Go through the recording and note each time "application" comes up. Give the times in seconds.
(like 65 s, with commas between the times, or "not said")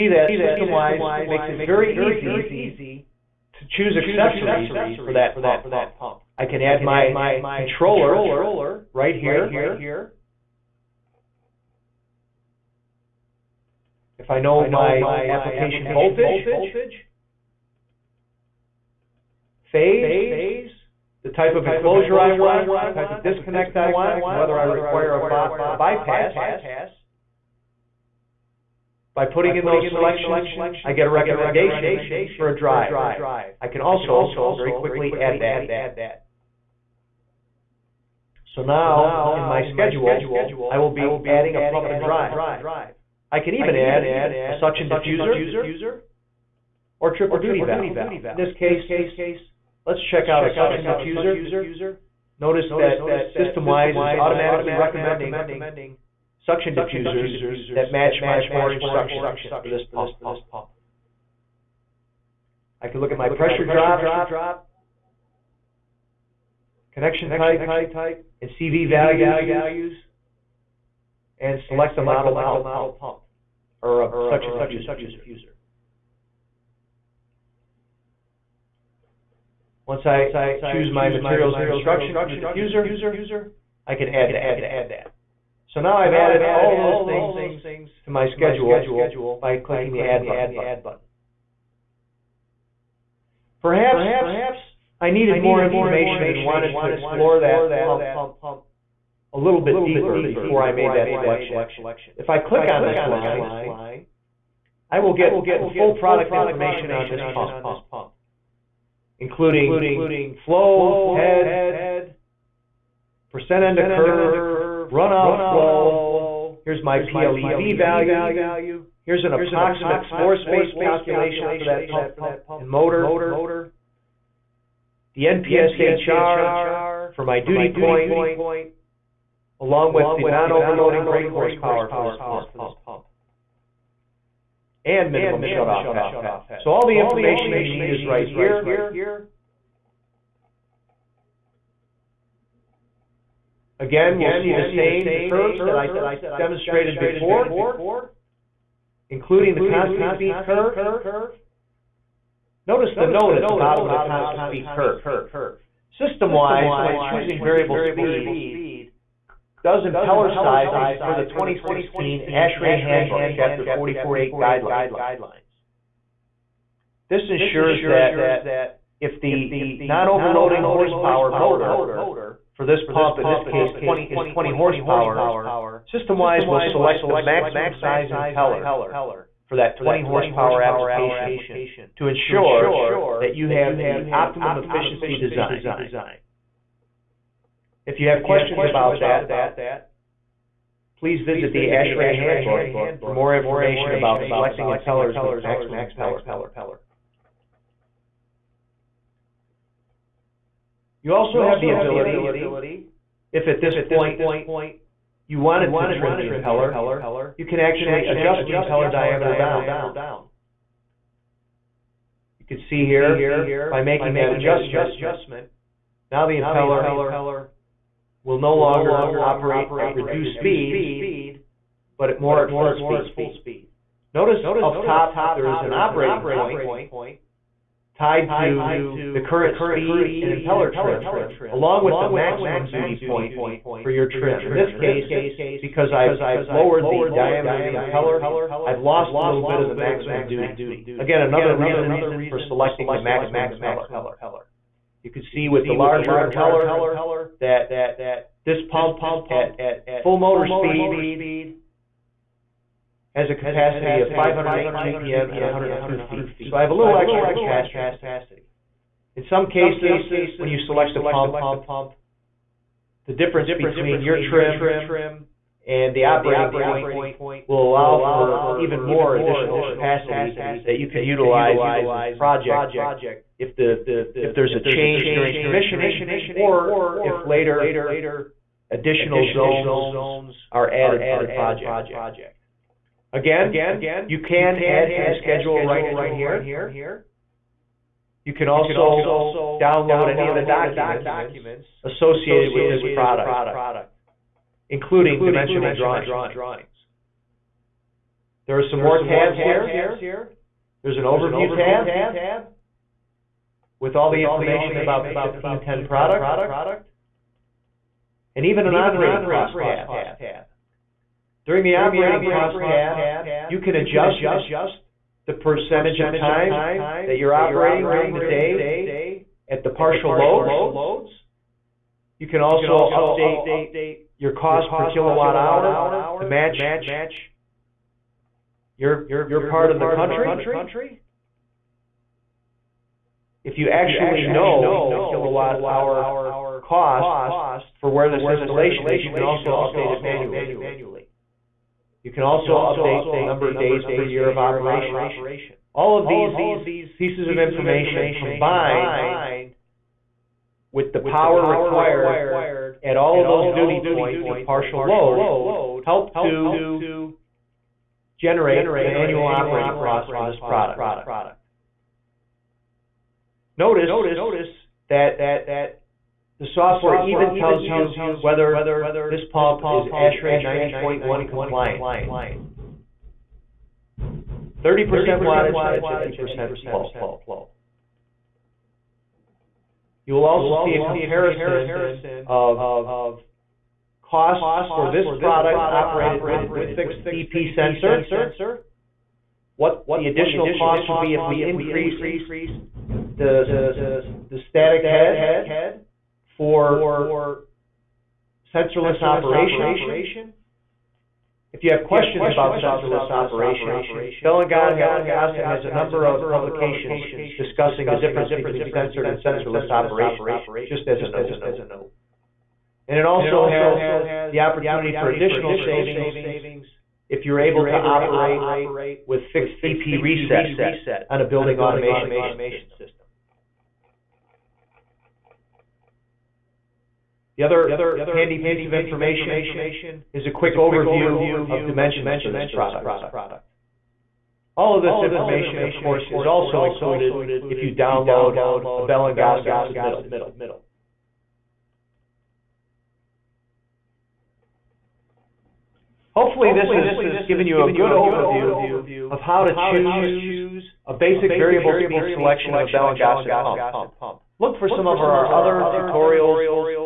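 15 s, 180 s.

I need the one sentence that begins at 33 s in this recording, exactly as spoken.
I can also very quickly add that.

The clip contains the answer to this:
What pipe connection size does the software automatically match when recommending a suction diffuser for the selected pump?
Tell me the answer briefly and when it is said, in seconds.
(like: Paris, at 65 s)
4-inch, at 58 s.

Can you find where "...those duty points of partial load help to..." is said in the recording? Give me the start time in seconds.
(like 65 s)
353 s.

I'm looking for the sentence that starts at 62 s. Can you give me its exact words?
I can look at my pressure drop connection type, and CV values, and select a model pump or a suction diffuser.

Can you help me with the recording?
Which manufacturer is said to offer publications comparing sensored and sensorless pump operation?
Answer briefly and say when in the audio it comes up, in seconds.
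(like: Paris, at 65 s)
Bell and Gossett, at 404 s.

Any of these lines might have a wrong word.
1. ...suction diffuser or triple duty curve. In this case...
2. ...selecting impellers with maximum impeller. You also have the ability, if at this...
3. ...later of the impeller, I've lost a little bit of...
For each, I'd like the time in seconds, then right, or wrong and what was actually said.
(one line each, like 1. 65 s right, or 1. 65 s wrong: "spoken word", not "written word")
1. 44 s wrong: "valve", not "curve"
2. 194 s right
3. 237 s wrong: "diameter", not "later".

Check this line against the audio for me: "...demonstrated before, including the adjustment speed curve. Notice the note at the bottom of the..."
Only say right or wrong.
wrong.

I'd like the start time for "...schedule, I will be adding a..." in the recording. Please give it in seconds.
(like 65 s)
39 s.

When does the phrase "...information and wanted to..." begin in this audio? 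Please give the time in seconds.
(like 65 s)
95 s.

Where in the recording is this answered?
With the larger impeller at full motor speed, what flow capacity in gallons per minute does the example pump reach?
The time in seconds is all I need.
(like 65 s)
254 s.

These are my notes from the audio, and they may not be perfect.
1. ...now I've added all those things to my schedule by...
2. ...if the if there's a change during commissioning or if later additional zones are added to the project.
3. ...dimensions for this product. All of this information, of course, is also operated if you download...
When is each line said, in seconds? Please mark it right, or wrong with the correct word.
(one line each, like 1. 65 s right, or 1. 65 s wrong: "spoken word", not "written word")
1. 85 s right
2. 273 s right
3. 431 s wrong: "included", not "operated".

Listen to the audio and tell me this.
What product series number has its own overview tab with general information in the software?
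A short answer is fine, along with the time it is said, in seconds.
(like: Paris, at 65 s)
1510, at 305 s.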